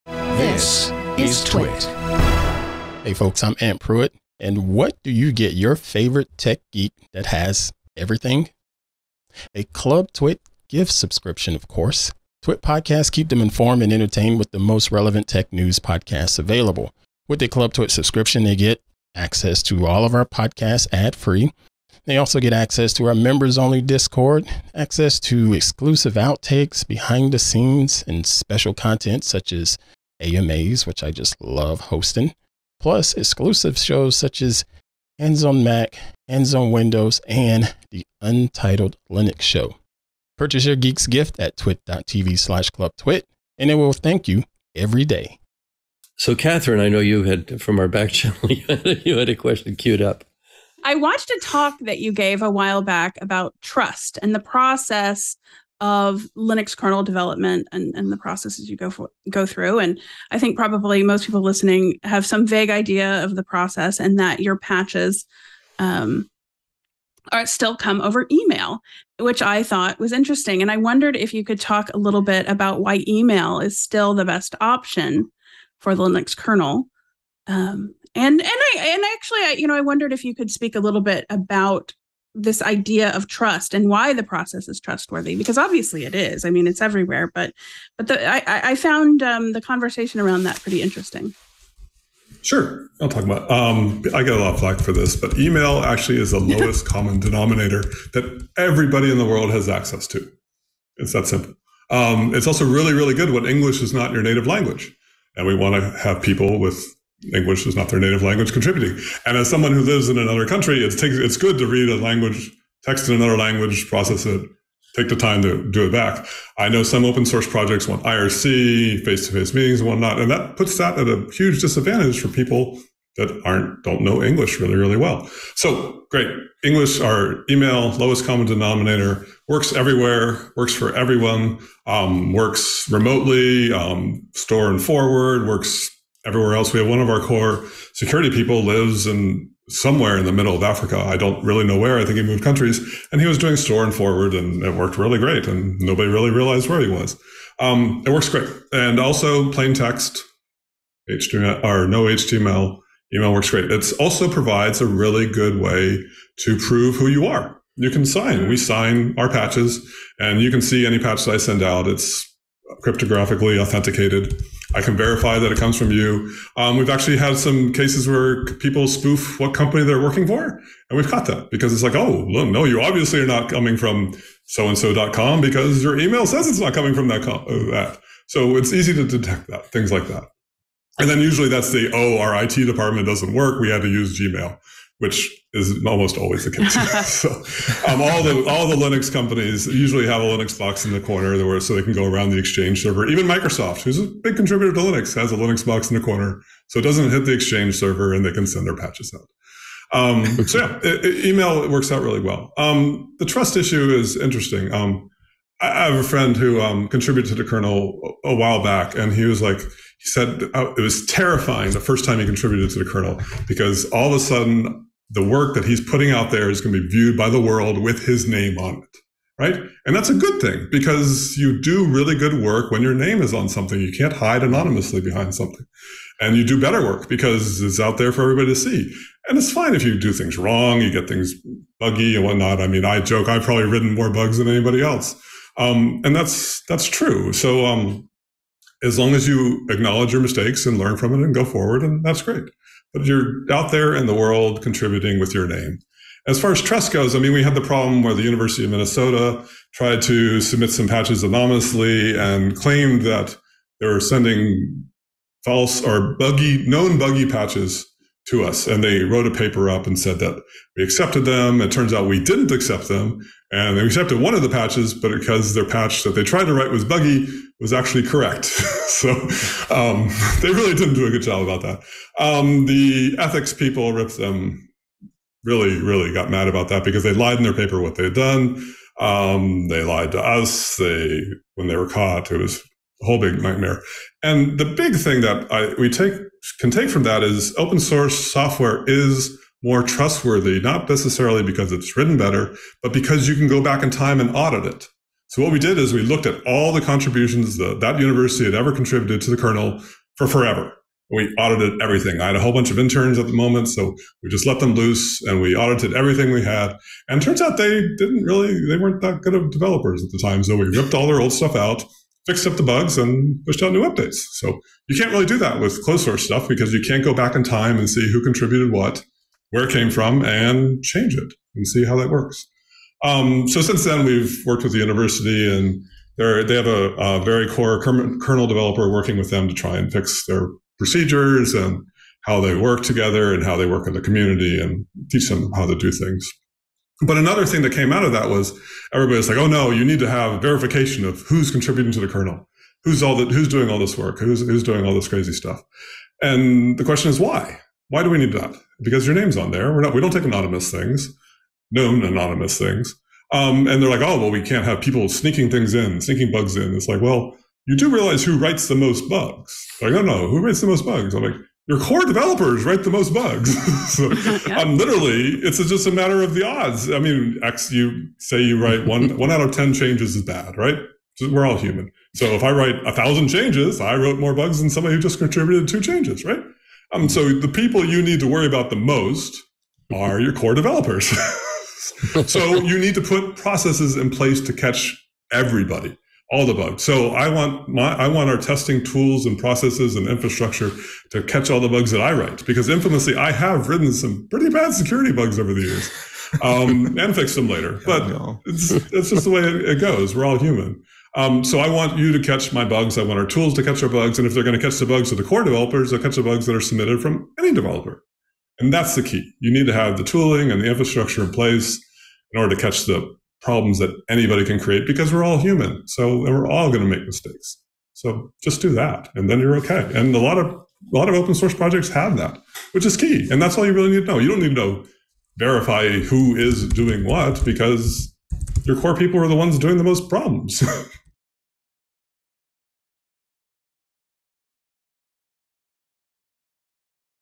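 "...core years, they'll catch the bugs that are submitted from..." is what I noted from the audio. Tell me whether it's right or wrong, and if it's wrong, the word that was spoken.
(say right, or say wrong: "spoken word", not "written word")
wrong: "developers", not "years".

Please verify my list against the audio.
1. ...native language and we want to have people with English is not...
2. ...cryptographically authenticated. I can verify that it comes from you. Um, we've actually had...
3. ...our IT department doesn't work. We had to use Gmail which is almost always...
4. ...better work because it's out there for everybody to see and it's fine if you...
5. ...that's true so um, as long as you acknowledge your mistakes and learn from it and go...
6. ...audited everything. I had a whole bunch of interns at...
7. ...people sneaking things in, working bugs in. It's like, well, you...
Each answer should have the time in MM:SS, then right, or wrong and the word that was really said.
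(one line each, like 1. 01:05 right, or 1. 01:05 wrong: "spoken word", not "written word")
1. 01:44 right
2. 02:42 right
3. 03:02 right
4. 03:46 right
5. 03:56 right
6. 05:01 right
7. 05:54 wrong: "sneaking", not "working".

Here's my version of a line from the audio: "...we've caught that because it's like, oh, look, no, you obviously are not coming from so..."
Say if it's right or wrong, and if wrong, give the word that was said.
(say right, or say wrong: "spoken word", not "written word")
right.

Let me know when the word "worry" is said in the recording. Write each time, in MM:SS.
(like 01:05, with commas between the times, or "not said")
06:18.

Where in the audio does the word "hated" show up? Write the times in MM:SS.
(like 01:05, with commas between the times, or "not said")
not said.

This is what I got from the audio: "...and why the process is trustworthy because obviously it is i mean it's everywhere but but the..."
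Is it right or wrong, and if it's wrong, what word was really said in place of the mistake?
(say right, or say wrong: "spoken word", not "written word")
right.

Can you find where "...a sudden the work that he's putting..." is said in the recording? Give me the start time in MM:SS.
03:34.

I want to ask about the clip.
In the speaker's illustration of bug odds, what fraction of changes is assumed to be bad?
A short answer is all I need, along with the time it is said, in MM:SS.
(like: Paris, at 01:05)
1 out of 10, at 06:09.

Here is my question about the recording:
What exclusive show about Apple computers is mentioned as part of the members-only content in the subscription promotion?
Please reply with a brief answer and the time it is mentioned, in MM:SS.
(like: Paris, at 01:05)
Hands on Mac, at 00:35.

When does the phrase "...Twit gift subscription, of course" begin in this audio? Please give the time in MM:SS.
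00:10.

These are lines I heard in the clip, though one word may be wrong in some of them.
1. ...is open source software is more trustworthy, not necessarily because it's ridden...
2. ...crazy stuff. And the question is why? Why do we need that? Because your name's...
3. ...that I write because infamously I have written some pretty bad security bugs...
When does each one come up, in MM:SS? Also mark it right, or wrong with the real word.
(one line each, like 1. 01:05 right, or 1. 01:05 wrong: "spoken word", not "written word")
1. 04:47 wrong: "written", not "ridden"
2. 05:45 right
3. 06:31 right.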